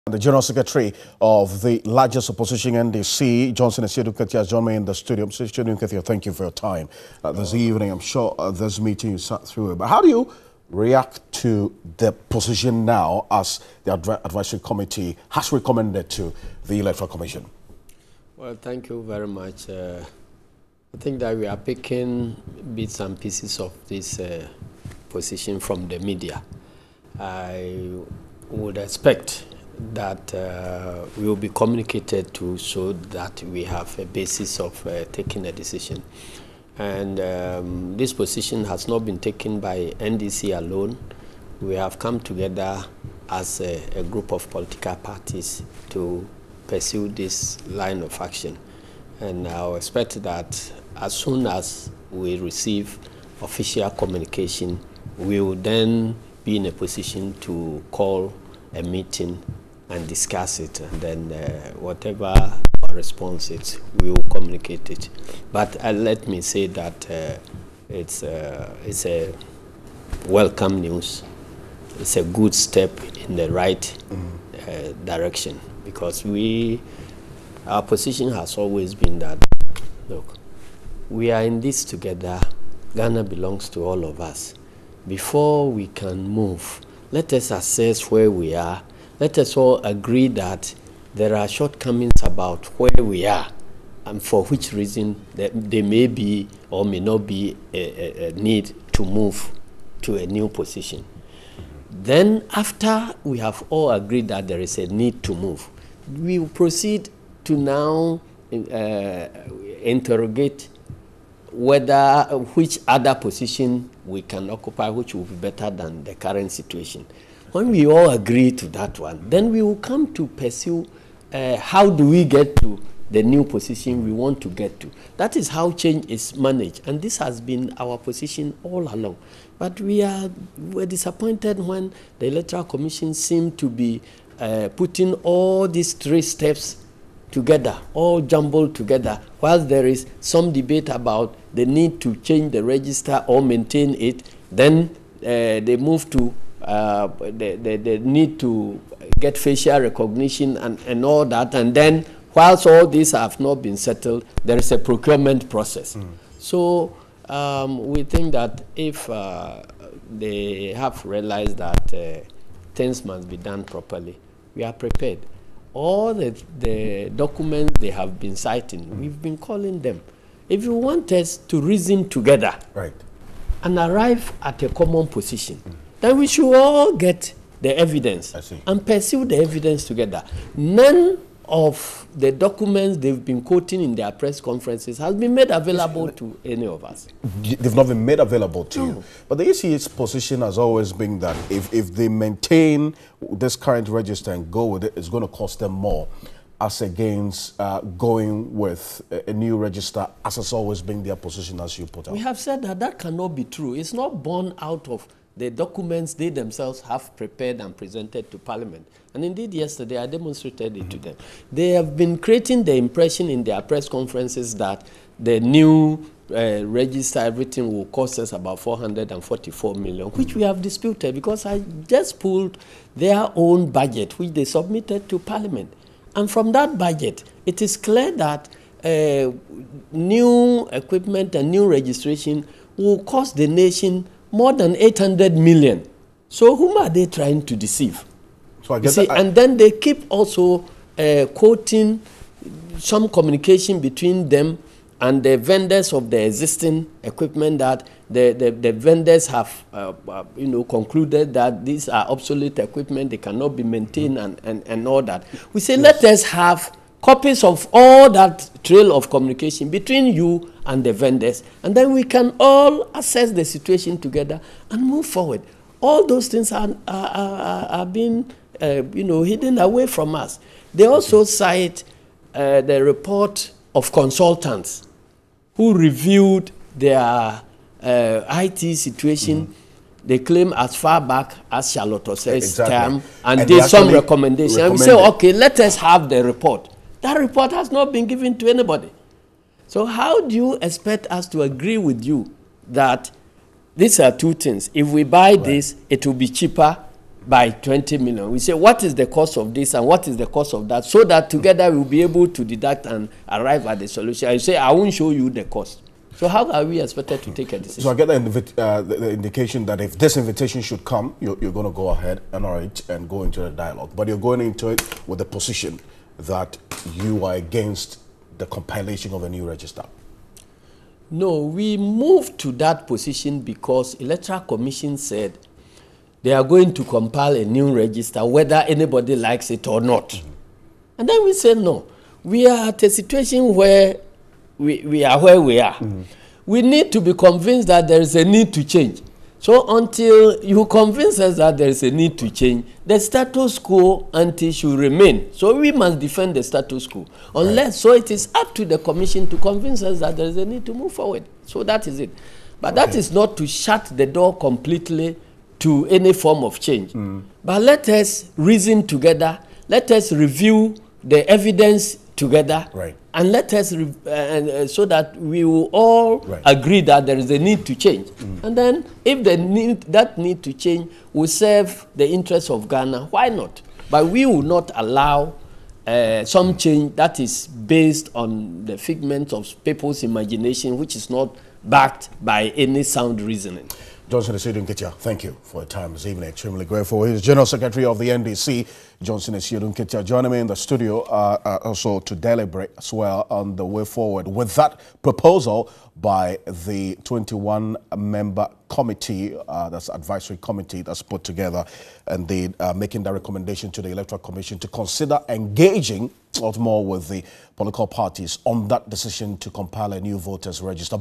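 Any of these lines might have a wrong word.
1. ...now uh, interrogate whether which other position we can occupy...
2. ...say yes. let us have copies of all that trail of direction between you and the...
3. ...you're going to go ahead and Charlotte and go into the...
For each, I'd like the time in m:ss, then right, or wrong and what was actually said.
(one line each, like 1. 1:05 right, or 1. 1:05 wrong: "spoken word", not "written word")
1. 1:47 right
2. 4:15 wrong: "communication", not "direction"
3. 5:11 wrong: "NRH", not "Charlotte".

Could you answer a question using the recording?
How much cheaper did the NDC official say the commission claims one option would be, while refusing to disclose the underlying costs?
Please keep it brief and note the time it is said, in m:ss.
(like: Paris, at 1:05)
20 million, at 4:57.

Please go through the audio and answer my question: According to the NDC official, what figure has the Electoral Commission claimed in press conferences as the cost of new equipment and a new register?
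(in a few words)
444 million.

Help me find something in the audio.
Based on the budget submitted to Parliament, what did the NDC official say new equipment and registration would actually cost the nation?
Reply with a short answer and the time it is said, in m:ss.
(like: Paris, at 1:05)
more than 800 million, at 3:54.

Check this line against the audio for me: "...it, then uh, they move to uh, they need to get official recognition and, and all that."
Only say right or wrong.
wrong.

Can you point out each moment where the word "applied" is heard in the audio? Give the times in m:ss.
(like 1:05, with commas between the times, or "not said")
not said.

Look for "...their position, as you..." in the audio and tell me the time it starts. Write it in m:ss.
3:21.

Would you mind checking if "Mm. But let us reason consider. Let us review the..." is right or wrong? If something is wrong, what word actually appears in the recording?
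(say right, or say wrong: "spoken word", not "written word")
wrong: "together", not "consider".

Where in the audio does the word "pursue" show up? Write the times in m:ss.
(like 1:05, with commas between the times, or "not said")
0:46, 2:00, 2:58.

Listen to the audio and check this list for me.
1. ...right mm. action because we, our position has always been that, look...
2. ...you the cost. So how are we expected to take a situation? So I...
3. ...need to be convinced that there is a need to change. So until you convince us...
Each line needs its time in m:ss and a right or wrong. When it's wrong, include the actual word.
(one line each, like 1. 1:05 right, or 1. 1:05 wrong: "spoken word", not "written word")
1. 1:13 wrong: "direction", not "action"
2. 5:05 wrong: "decision", not "situation"
3. 5:36 right.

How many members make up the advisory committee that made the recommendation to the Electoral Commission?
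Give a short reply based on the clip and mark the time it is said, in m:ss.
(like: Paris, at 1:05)
21, at 6:37.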